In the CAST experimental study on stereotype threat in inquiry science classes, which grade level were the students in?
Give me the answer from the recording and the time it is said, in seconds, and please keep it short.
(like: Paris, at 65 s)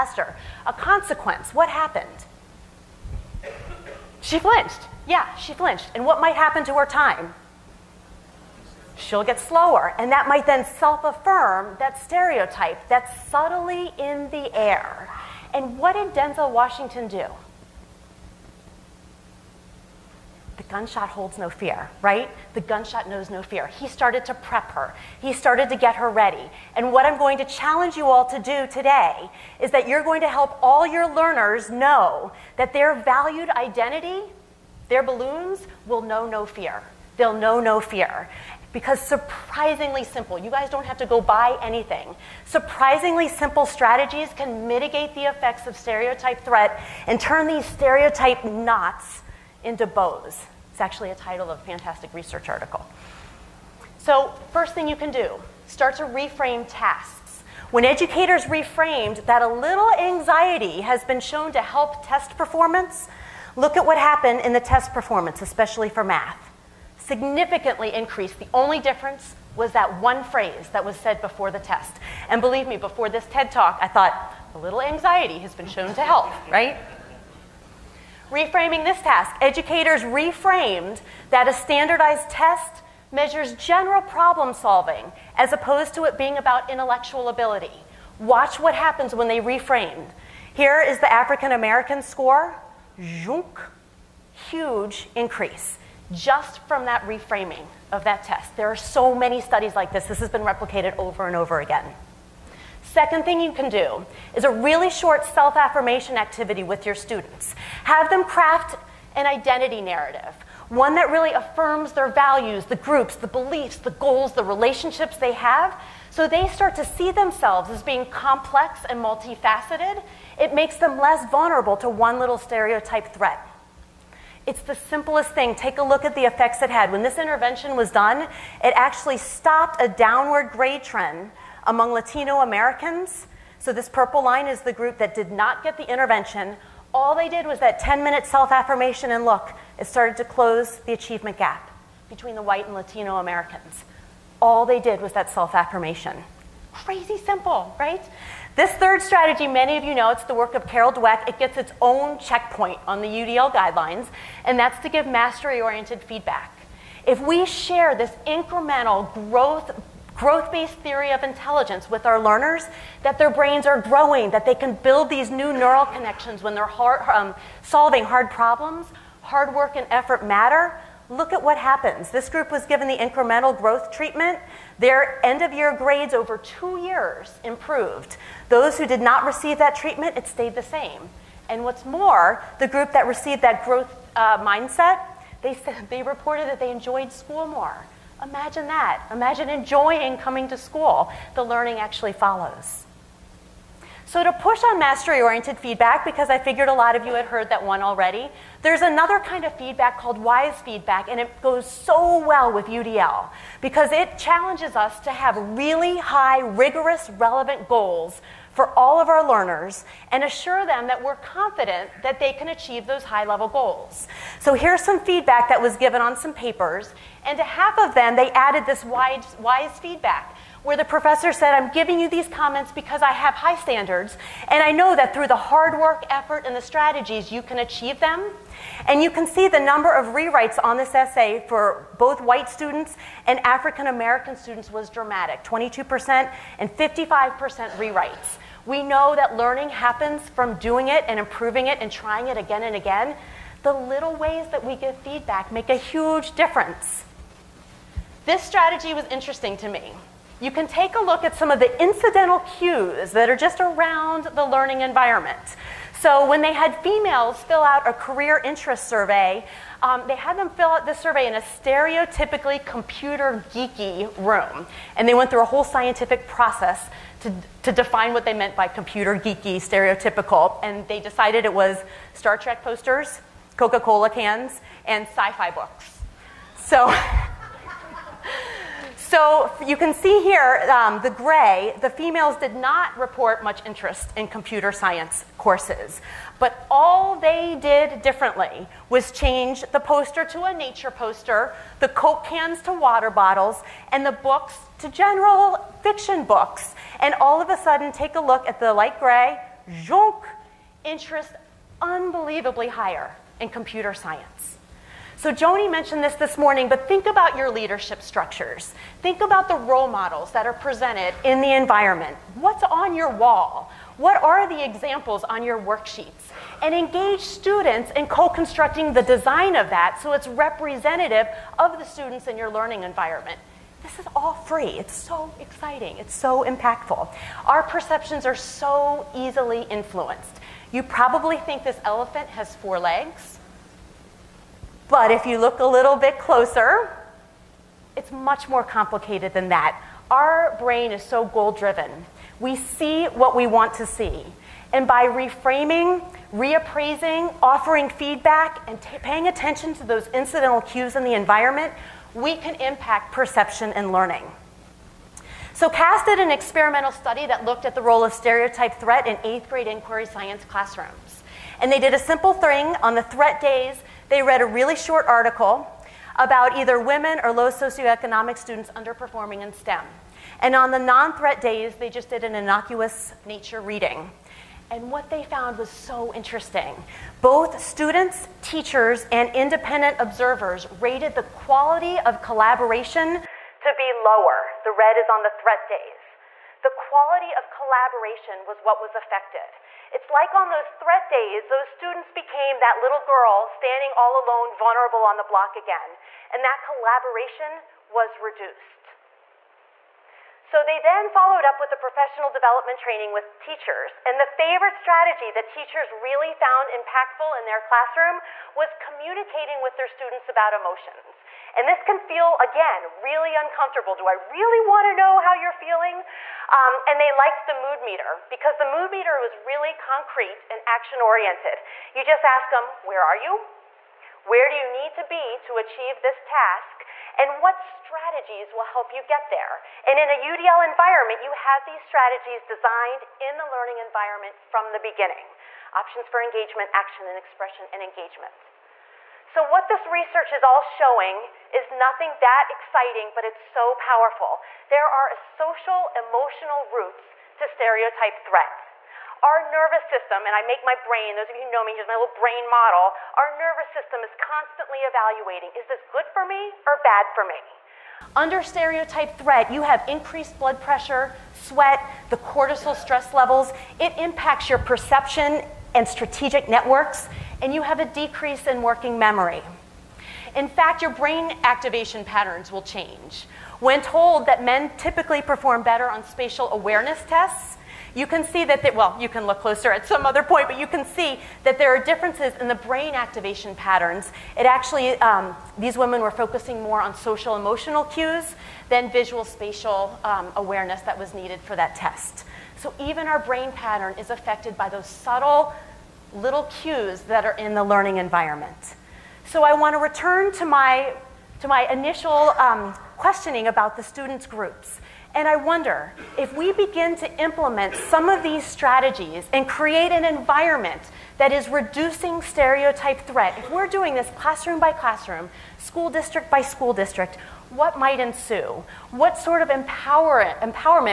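eighth grade, at 359 s.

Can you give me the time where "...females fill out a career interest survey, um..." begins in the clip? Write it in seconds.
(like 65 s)
256 s.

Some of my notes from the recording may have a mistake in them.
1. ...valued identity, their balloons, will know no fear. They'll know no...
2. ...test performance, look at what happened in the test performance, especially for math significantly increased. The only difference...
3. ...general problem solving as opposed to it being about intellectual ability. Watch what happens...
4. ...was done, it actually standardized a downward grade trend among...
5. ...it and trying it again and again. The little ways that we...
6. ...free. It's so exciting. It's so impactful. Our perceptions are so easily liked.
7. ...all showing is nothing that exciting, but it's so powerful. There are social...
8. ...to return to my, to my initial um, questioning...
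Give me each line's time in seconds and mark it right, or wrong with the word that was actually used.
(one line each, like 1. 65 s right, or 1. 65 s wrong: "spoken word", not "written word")
1. 32 s right
2. 62 s right
3. 83 s right
4. 127 s wrong: "stopped", not "standardized"
5. 241 s right
6. 324 s wrong: "influenced", not "liked"
7. 440 s right
8. 499 s right.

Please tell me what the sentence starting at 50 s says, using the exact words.
It's actually a title of a fantastic research article.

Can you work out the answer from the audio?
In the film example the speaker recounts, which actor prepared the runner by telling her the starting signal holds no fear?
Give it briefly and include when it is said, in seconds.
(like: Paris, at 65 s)
Denzel Washington, at 16 s.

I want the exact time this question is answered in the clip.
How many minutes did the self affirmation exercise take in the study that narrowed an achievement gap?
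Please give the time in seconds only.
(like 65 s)
137 s.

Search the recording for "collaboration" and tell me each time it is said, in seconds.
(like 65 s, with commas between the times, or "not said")
382 s, 387 s, 396 s.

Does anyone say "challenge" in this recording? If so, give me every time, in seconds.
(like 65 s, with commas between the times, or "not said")
27 s, 204 s.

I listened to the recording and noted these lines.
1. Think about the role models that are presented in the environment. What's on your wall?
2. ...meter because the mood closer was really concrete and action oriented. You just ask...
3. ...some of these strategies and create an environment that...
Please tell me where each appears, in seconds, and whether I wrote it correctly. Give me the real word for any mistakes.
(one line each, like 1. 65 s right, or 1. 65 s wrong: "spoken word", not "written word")
1. 309 s right
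2. 417 s wrong: "meter", not "closer"
3. 507 s right.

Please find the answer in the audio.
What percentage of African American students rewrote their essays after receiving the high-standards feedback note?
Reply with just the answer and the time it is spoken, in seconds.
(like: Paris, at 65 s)
55%, at 236 s.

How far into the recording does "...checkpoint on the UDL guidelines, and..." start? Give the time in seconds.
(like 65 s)
152 s.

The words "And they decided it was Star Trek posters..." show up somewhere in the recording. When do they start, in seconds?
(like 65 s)
270 s.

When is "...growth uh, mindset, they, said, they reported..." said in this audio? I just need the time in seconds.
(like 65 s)
183 s.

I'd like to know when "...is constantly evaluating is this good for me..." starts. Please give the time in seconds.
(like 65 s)
454 s.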